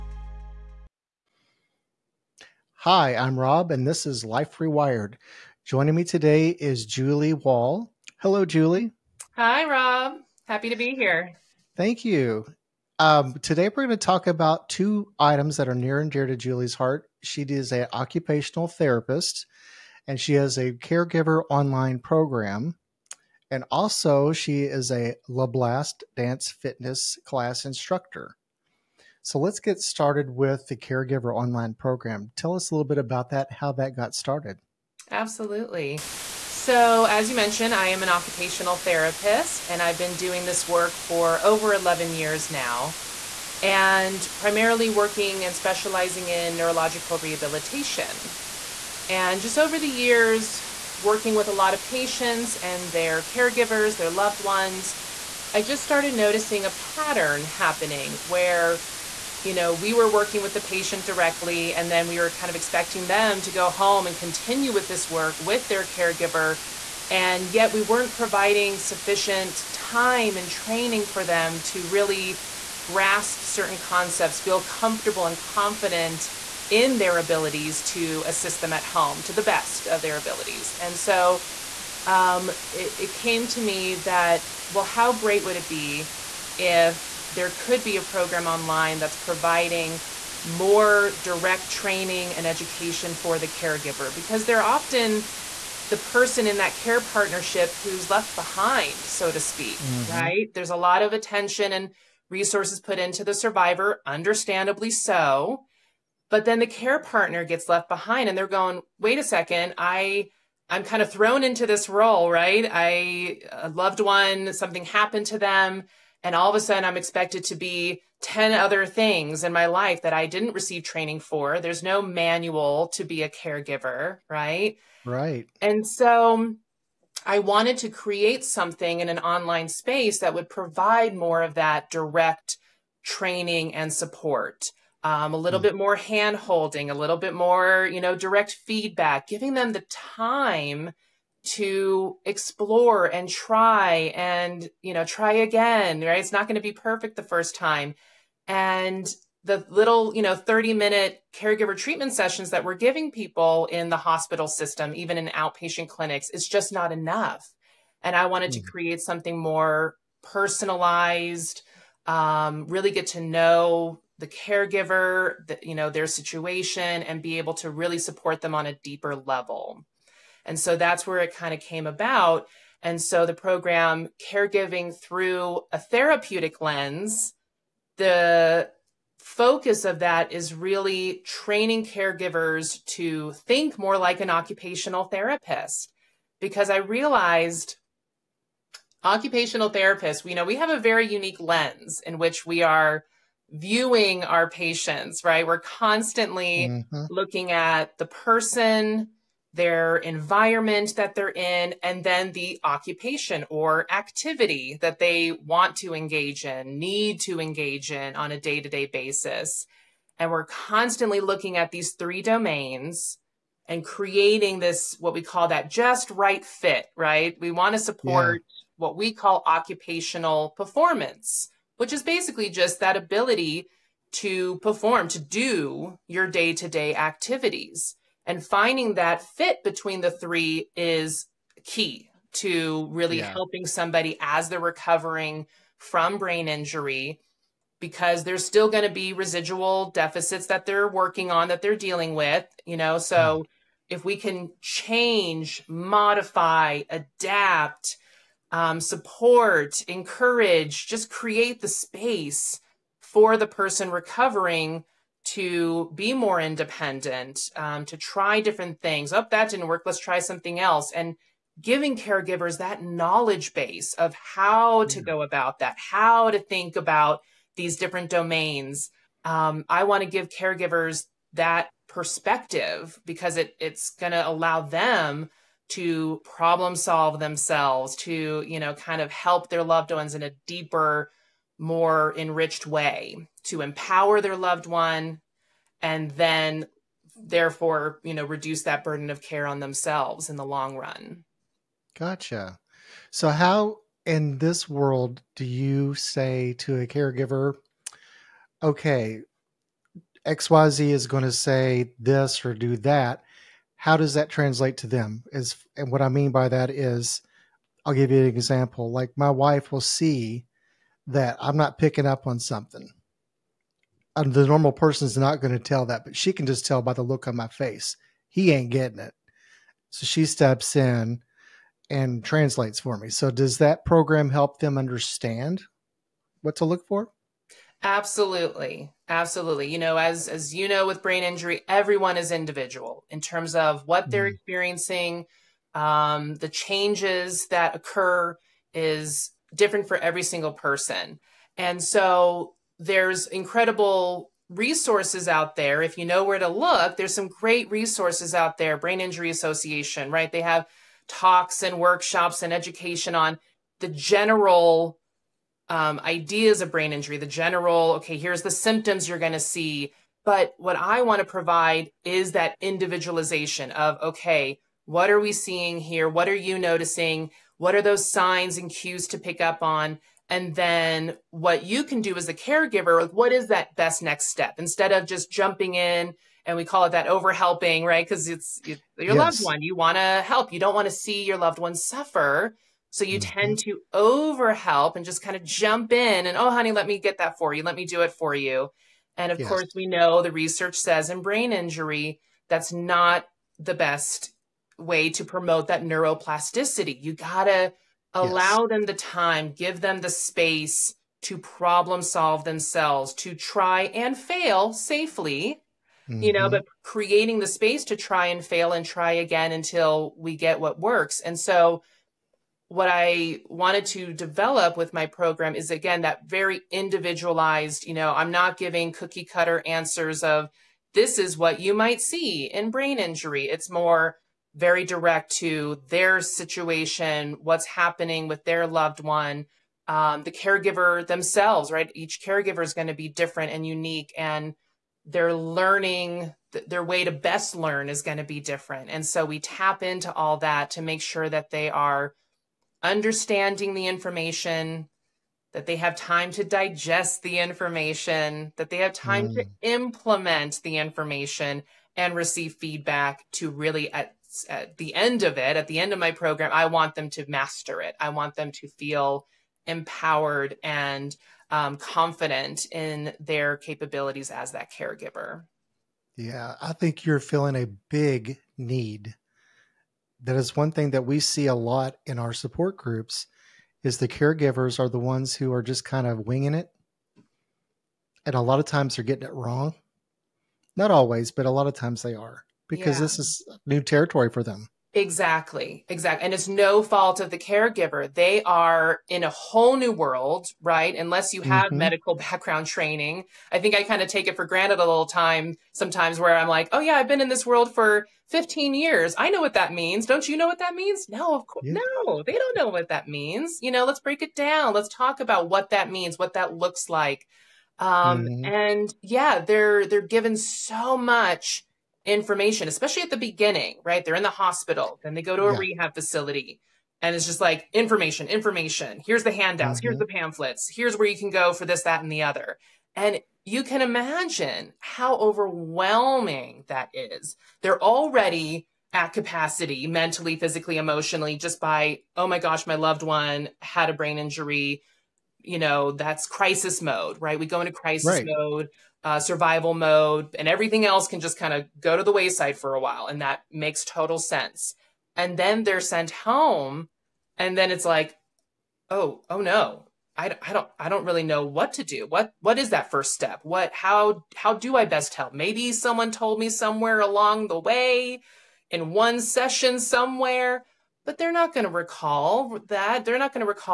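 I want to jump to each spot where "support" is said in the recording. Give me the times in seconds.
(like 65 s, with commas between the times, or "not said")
133 s, 167 s, 217 s, 248 s, 472 s.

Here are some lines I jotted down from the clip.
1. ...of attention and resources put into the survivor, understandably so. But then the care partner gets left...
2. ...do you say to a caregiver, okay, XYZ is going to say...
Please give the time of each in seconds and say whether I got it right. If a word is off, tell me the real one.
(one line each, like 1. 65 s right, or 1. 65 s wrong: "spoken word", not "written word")
1. 101 s right
2. 295 s right.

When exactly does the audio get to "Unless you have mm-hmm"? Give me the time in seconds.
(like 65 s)
490 s.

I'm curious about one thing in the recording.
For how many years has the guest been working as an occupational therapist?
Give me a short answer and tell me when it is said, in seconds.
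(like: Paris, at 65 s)
11, at 41 s.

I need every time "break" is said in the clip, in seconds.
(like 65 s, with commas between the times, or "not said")
503 s.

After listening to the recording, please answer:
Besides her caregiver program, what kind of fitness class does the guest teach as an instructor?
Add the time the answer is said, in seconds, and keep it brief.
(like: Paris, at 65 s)
Blast dance fitness, at 25 s.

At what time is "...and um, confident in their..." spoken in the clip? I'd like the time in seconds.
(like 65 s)
460 s.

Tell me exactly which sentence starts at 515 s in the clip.
rehab facility, and it's just like information, information.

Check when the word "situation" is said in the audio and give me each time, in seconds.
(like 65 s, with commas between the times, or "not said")
166 s, 426 s.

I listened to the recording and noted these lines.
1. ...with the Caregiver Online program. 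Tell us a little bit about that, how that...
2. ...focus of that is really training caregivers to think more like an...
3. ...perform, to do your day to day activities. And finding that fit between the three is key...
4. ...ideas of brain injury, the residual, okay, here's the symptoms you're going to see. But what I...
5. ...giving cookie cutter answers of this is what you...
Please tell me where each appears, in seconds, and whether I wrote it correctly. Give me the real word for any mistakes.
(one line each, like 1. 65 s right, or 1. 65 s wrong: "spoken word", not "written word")
1. 30 s right
2. 179 s right
3. 224 s right
4. 356 s wrong: "general", not "residual"
5. 418 s right.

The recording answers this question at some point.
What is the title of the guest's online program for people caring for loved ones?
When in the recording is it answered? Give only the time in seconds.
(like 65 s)
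174 s.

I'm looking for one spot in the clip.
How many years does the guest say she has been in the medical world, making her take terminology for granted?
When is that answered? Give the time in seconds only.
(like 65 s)
498 s.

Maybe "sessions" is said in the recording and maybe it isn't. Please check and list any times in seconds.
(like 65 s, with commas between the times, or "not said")
152 s, 559 s.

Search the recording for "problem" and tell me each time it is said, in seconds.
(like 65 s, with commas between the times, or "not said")
276 s, 401 s.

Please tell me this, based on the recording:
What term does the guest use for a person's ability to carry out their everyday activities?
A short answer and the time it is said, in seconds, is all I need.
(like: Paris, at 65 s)
occupational performance, at 219 s.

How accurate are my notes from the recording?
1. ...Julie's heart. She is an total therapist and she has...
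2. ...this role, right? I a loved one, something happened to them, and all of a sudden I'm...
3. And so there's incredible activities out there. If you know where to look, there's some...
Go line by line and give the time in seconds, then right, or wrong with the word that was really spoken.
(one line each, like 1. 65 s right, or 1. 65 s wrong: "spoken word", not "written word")
1. 16 s wrong: "occupational", not "total"
2. 111 s right
3. 341 s wrong: "resources", not "activities".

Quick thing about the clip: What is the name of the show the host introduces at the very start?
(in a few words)
Life Rewired.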